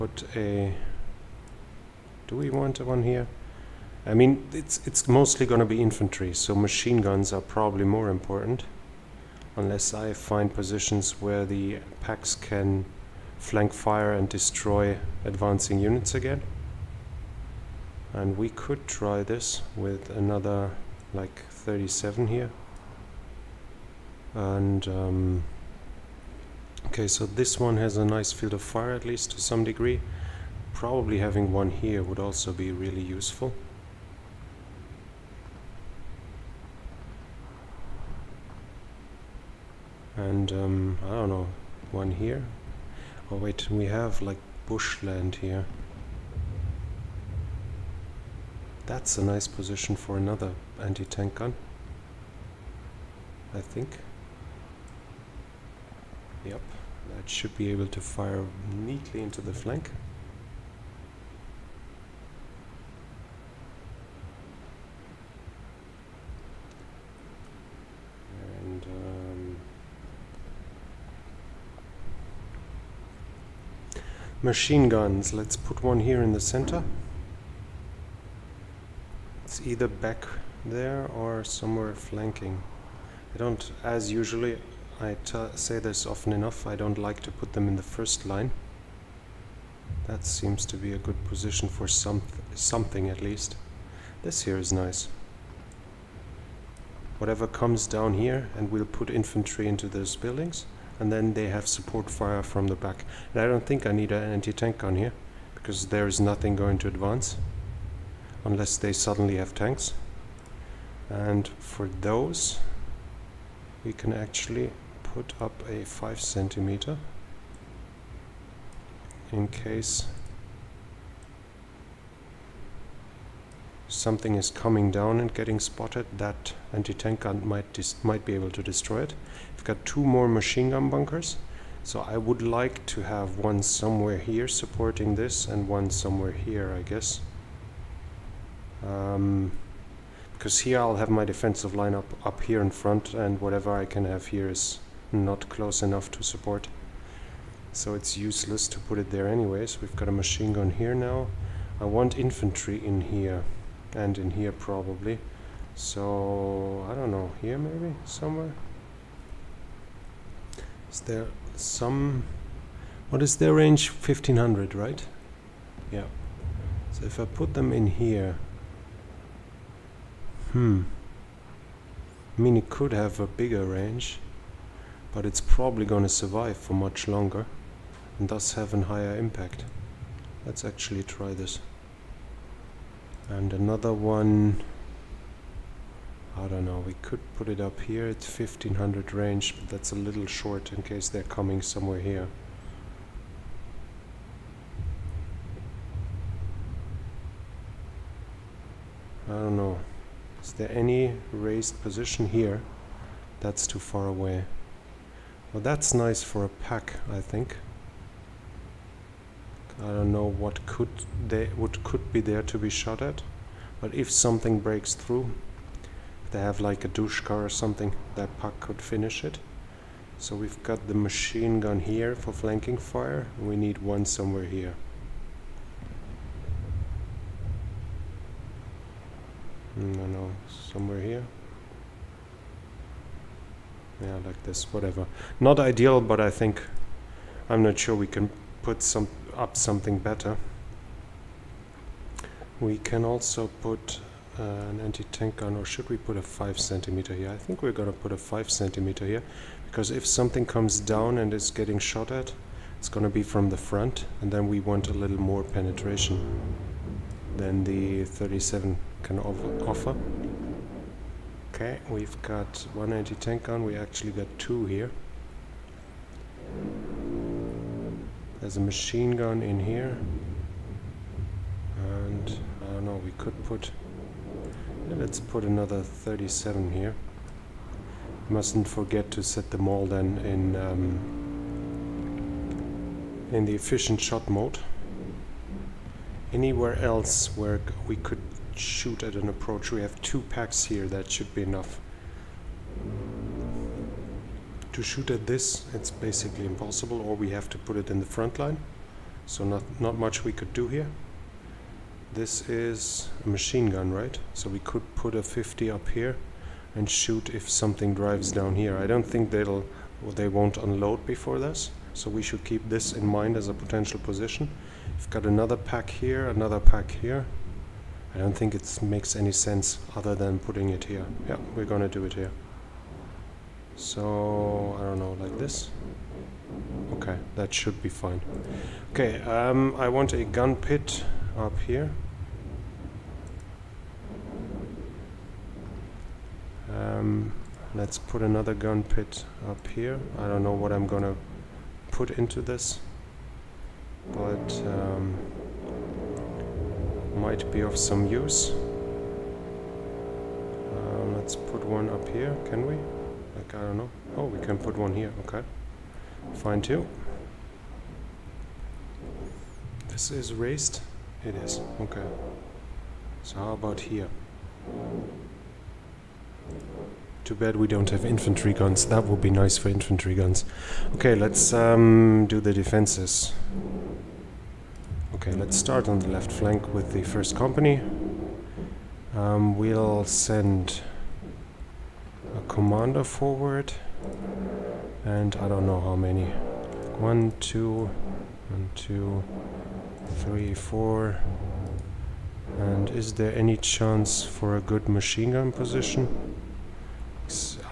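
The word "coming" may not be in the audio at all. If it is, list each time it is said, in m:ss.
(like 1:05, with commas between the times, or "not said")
2:04, 3:11.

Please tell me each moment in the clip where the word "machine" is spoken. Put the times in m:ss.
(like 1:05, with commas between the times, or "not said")
0:06, 1:14, 2:10, 2:30, 3:40, 4:28, 5:03, 6:34.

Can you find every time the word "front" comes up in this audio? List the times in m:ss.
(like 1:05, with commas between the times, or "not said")
2:22, 4:13, 4:58.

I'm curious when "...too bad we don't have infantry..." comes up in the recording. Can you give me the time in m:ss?
6:07.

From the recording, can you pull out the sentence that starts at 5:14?
We've got another PaK here, another PaK here.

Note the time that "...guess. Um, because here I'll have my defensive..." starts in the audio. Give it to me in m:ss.
2:16.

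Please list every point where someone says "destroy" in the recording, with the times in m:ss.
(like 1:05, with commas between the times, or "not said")
0:14, 2:08.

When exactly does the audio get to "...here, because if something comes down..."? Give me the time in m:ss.
4:09.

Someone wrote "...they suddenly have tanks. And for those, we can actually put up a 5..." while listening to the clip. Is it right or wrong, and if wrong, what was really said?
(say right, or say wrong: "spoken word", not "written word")
right.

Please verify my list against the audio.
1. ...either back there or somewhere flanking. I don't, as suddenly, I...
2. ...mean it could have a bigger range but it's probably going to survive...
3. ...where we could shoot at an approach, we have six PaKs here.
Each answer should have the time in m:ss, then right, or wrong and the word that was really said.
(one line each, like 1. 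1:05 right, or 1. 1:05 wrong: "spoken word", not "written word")
1. 1:19 wrong: "usually", not "suddenly"
2. 2:52 right
3. 4:47 wrong: "two", not "six".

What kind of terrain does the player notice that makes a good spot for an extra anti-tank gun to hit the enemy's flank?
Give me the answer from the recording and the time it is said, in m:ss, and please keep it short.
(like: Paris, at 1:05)
bushland, at 0:44.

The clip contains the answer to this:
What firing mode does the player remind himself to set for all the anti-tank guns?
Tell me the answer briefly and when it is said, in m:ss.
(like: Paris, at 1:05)
efficient shot mode, at 4:43.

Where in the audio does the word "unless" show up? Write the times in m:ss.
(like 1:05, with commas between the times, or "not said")
0:09, 1:48.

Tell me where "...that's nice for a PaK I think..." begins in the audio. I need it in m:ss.
3:25.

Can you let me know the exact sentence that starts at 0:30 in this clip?
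Probably having one here would also be really useful.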